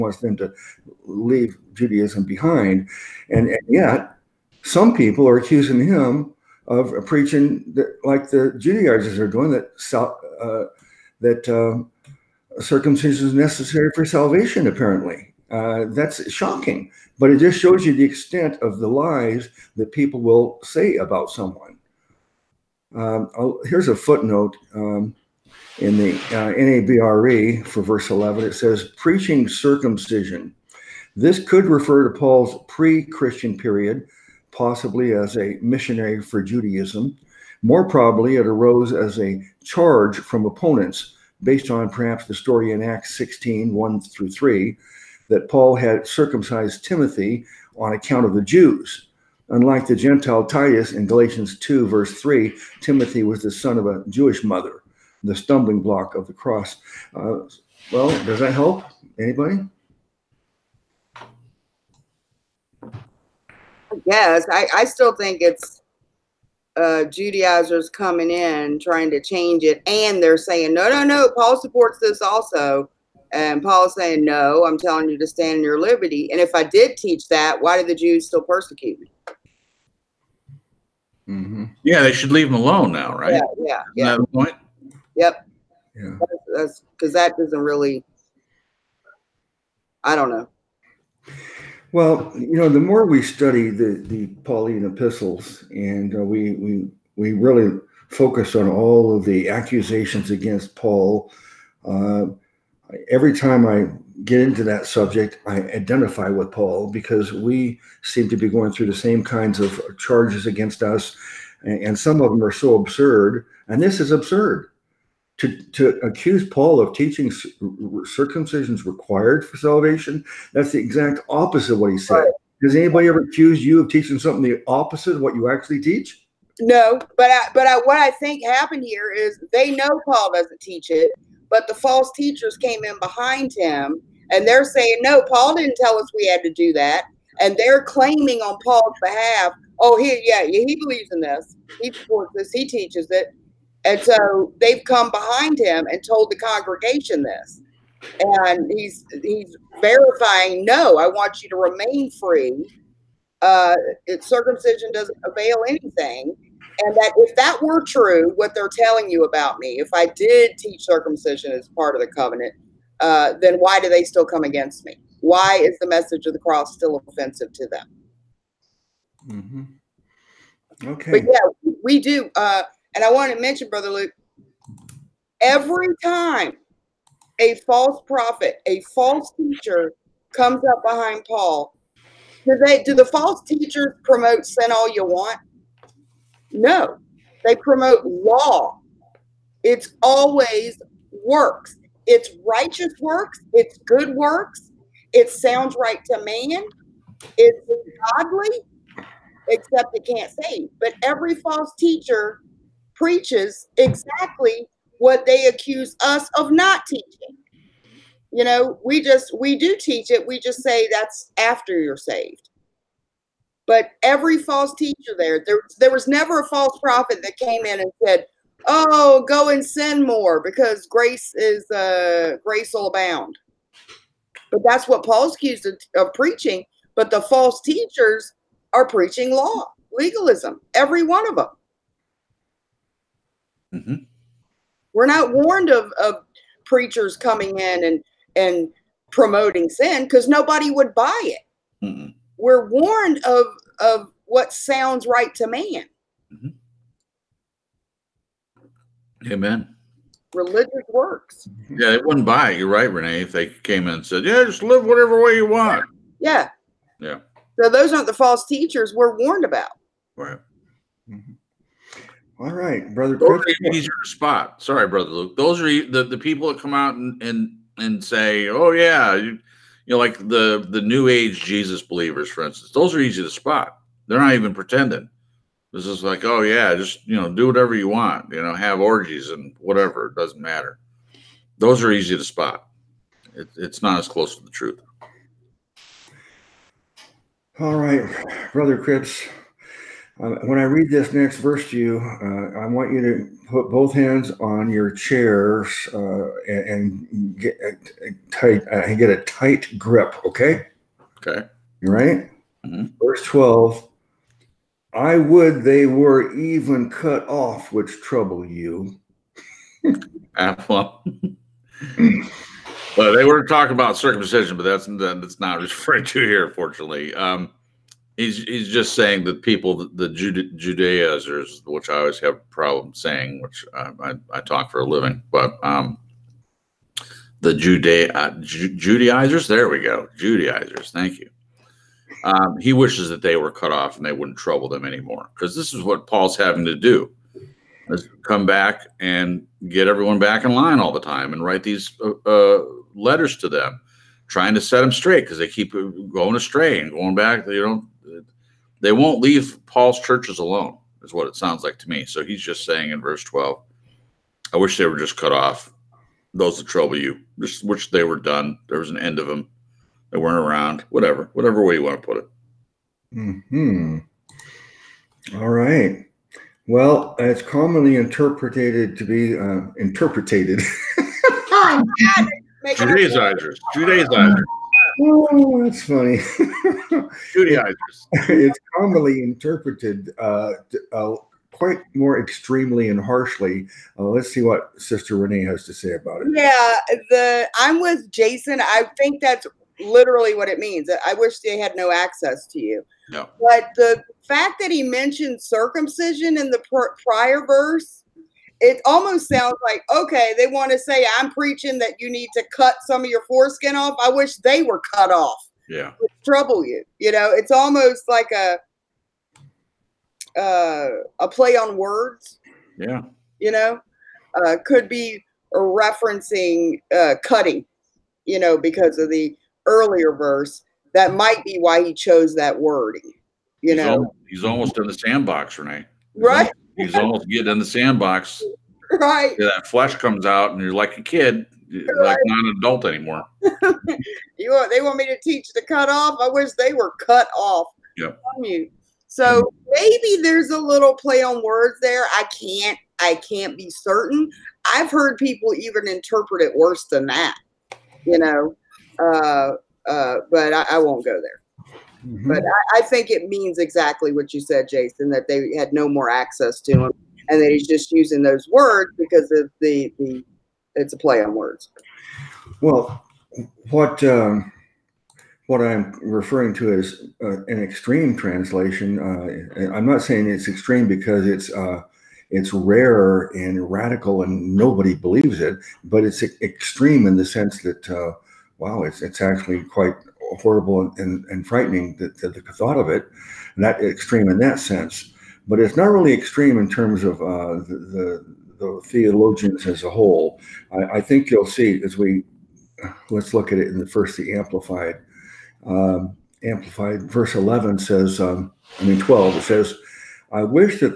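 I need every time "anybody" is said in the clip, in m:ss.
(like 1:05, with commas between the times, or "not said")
0:59, 2:02.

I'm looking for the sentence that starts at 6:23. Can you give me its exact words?
Uh, let's see what Sister Renee has to say about it.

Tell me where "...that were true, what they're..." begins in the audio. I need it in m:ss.
2:37.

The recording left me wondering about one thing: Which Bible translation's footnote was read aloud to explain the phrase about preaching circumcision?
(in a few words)
NABRE.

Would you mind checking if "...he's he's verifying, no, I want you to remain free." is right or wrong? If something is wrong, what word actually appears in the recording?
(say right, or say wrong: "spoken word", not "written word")
right.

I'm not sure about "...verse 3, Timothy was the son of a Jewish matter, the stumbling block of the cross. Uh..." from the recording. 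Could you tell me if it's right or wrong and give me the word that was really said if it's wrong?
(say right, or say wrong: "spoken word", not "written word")
wrong: "mother", not "matter".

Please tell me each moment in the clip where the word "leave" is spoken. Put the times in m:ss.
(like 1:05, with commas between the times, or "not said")
0:01, 1:22, 5:49.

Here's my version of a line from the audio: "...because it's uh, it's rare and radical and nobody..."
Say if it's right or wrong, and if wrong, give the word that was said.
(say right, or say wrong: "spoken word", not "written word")
right.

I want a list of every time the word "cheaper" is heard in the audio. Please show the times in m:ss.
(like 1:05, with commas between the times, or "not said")
not said.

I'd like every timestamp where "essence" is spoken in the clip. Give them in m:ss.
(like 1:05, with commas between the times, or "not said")
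not said.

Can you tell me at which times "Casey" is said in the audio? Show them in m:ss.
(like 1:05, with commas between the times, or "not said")
not said.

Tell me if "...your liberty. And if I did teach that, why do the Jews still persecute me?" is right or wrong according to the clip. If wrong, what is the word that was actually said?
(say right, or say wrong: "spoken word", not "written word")
right.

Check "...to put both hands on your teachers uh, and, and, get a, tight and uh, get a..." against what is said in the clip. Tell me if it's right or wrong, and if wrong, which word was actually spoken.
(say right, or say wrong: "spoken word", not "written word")
wrong: "chairs", not "teachers".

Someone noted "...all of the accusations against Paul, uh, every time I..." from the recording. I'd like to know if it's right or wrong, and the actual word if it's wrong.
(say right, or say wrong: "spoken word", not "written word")
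right.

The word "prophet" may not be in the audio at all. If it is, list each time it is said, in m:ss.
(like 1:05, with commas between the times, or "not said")
2:58, 3:36.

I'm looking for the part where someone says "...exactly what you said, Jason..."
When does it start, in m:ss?
7:33.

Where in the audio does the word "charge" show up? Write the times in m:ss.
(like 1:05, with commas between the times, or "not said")
0:39, 1:49.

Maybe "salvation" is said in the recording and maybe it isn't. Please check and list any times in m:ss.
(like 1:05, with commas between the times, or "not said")
0:14, 1:59.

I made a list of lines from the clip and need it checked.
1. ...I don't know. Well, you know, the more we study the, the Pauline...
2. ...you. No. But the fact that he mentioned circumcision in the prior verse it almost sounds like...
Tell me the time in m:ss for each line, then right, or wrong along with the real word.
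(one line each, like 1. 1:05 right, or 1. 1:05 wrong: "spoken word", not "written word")
1. 1:30 right
2. 6:32 right.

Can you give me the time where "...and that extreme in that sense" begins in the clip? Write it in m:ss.
8:03.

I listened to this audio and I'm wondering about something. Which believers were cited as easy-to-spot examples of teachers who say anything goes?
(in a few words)
New Age Jesus believers.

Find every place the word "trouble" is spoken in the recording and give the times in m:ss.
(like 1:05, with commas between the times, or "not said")
5:07, 5:34, 5:56, 6:46.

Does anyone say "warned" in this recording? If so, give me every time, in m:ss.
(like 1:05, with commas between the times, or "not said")
3:55, 4:02, 4:19.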